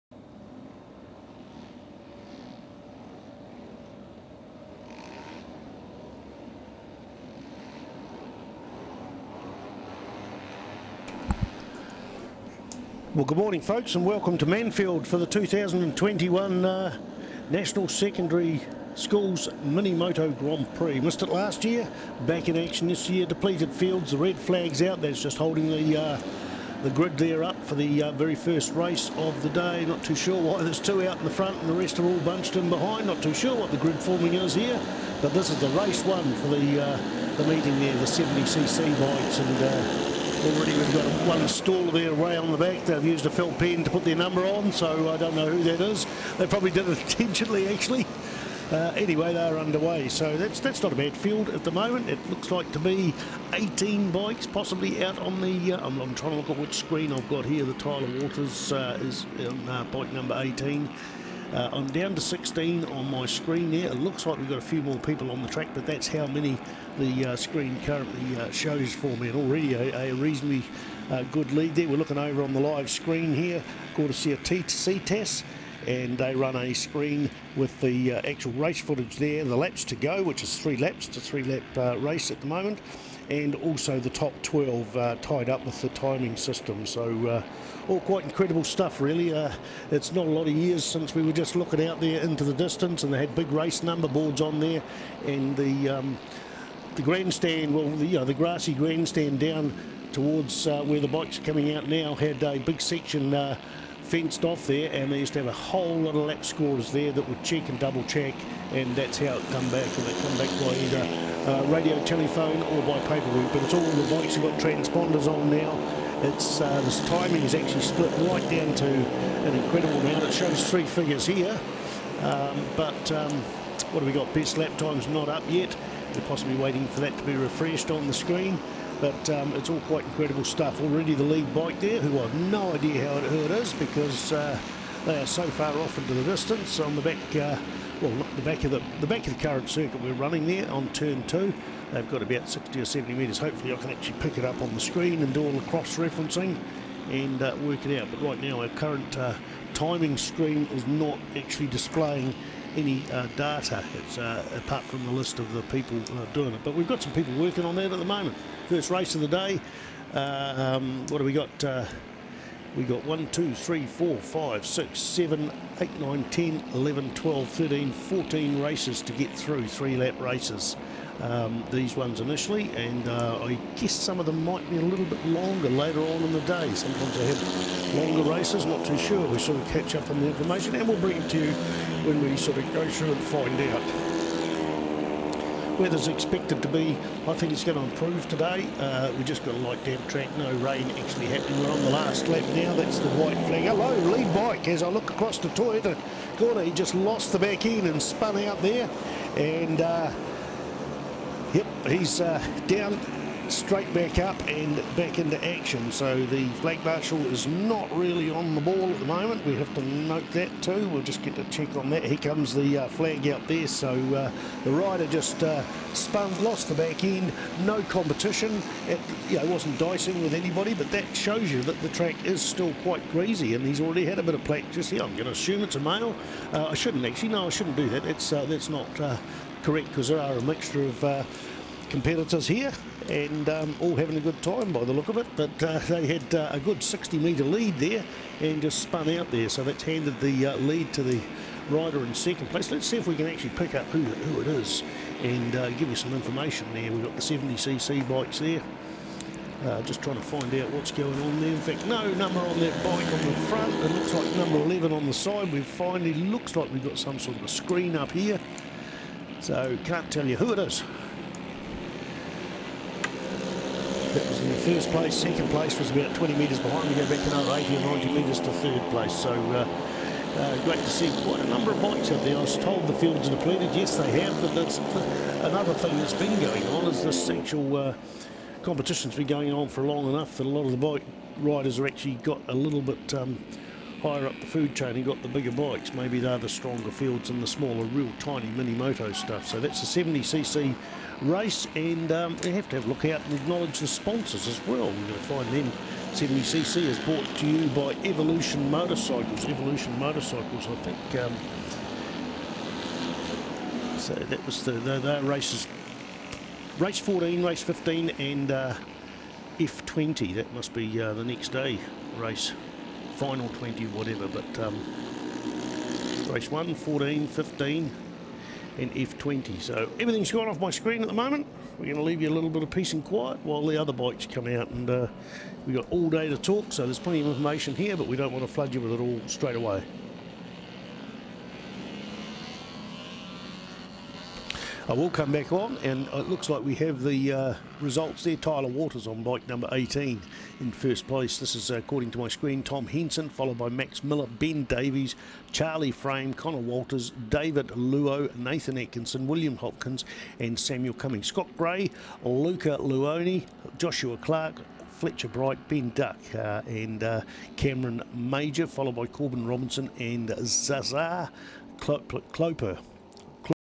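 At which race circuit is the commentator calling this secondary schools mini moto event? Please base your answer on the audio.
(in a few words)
Manfield.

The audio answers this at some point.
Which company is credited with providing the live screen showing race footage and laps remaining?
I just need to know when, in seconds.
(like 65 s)
74 s.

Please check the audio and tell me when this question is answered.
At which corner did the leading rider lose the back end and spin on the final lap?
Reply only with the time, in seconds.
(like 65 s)
195 s.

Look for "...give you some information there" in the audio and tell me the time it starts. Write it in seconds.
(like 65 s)
245 s.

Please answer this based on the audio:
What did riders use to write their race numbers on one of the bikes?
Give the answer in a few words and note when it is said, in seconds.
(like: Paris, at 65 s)
a felt pen, at 43 s.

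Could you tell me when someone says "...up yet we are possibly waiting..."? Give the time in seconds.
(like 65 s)
125 s.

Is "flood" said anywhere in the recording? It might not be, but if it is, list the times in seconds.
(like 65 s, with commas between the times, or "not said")
328 s.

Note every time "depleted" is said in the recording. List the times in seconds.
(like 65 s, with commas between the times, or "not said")
23 s, 273 s.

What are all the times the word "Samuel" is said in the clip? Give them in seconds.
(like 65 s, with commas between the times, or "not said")
350 s.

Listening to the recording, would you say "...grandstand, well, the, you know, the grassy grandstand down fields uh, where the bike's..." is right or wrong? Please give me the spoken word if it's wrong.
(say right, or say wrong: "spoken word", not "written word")
wrong: "towards", not "fields".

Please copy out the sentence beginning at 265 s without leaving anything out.
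Second place was about 20 metres behind.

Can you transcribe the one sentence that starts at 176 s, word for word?
Sometimes they have longer races, not too sure.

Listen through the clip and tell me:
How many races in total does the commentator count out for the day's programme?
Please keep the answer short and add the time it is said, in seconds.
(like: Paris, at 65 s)
14, at 167 s.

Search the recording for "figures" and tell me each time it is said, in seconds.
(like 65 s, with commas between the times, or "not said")
120 s.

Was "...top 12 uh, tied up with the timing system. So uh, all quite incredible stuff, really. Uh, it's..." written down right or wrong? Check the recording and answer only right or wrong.
right.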